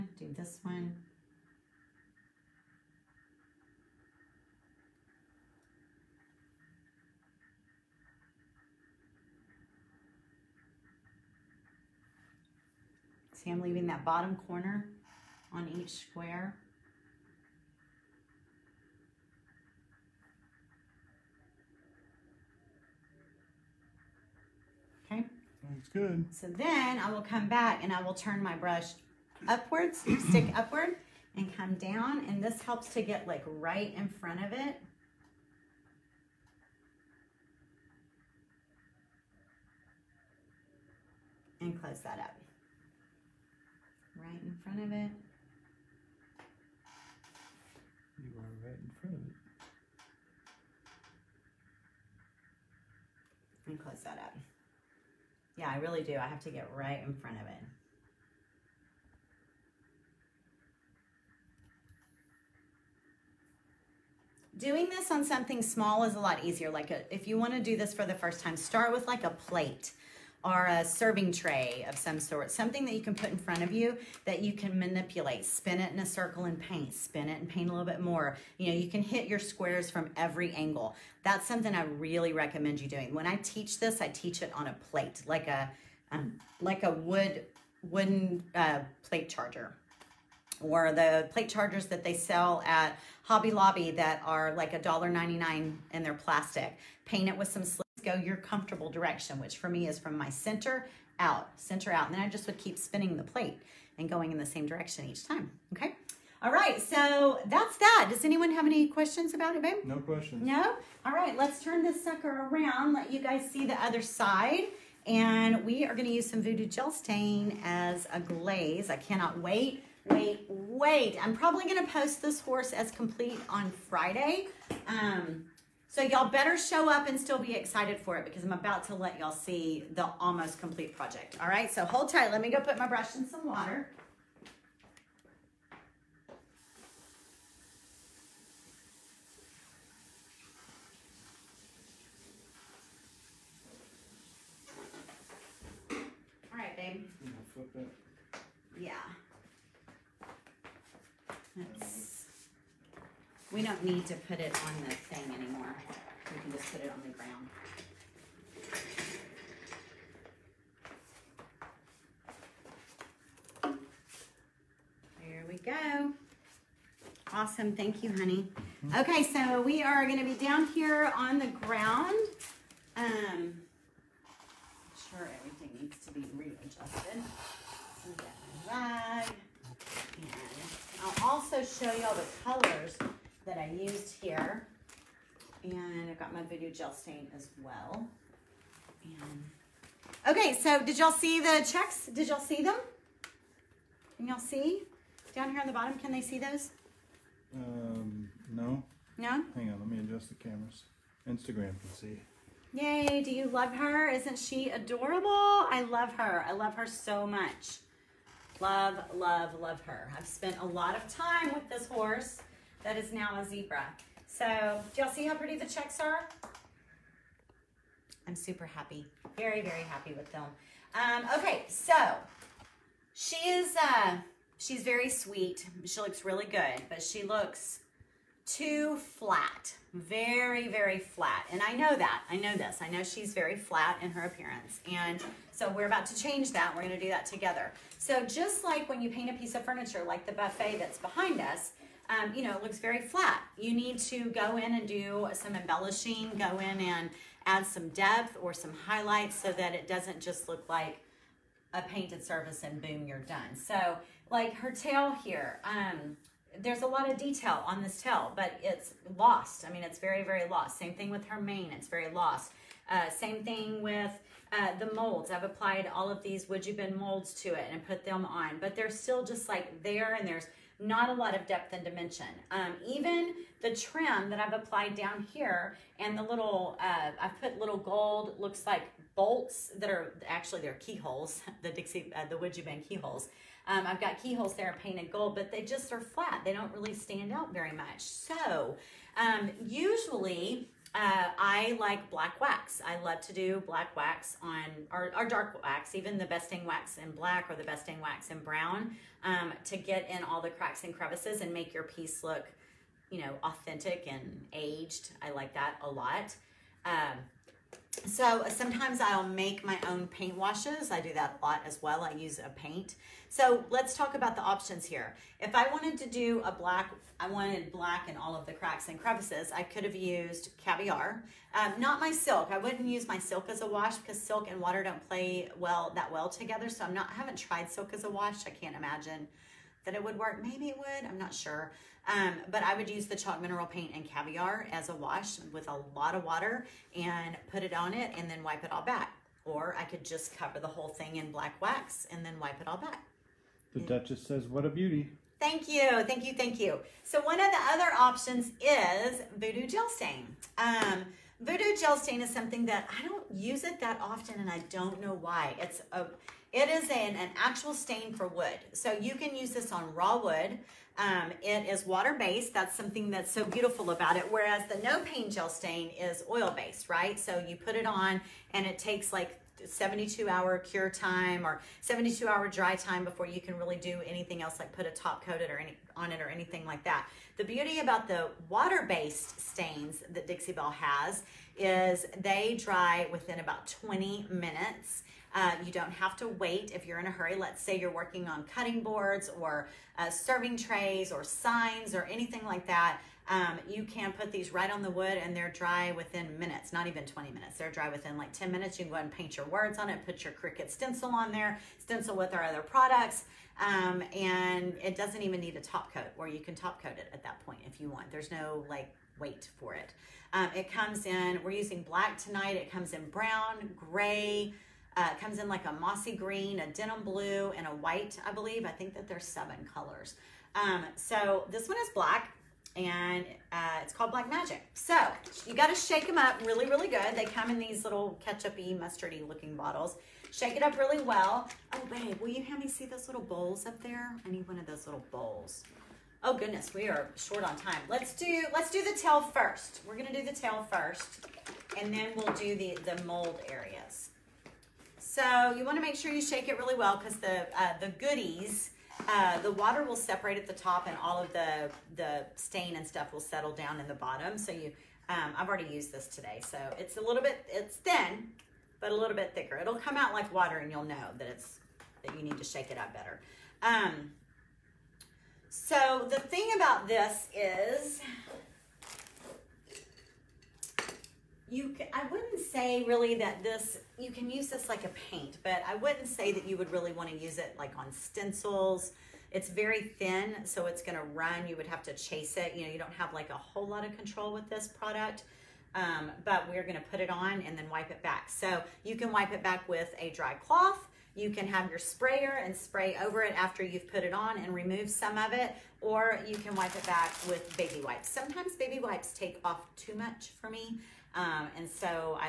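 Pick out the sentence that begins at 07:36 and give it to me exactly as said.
So it's a little bit, it's thin, but a little bit thicker.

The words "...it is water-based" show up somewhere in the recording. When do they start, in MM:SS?
06:01.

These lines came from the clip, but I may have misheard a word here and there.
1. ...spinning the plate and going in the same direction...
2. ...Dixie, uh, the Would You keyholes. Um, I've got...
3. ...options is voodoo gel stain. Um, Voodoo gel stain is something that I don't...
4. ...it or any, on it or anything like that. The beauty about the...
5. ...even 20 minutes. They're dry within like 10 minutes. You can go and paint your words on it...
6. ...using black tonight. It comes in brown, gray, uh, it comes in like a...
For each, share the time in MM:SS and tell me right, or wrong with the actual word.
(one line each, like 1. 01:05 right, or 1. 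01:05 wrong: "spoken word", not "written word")
1. 01:42 right
2. 04:41 right
3. 05:47 right
4. 06:15 right
5. 06:36 right
6. 06:51 right.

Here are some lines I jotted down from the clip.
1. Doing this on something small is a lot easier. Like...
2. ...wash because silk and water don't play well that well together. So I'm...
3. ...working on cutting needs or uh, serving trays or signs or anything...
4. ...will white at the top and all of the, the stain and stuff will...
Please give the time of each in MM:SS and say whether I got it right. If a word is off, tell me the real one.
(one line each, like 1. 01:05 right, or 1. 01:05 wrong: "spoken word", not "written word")
1. 01:04 right
2. 05:23 right
3. 06:27 wrong: "boards", not "needs"
4. 07:29 wrong: "separate", not "white".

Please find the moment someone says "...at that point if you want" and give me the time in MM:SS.
06:47.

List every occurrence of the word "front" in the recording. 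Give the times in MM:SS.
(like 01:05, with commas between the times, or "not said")
00:34, 00:44, 00:49, 00:57, 01:13.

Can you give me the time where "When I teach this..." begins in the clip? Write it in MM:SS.
01:23.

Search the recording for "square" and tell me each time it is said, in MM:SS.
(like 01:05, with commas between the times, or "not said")
00:15, 01:19.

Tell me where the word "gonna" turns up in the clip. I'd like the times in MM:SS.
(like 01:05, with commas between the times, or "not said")
01:55, 02:01, 07:19.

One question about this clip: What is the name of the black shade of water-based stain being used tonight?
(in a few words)
Black Magic.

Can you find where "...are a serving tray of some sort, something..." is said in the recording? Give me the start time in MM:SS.
01:10.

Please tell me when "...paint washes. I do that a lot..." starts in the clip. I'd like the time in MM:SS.
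05:10.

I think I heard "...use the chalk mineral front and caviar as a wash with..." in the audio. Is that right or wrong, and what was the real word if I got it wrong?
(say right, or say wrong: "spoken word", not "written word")
wrong: "paint", not "front".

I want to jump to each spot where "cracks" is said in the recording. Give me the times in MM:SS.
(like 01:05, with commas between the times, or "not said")
05:00, 05:18.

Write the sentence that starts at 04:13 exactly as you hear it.
So like her tail here, um, there's a lot of detail on this tail, but it's lost.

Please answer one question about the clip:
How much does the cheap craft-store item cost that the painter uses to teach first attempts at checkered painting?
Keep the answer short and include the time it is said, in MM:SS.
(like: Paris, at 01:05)
$1.99, at 01:34.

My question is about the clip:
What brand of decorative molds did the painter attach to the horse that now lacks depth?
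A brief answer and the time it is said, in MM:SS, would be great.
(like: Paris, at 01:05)
WoodUBend, at 04:26.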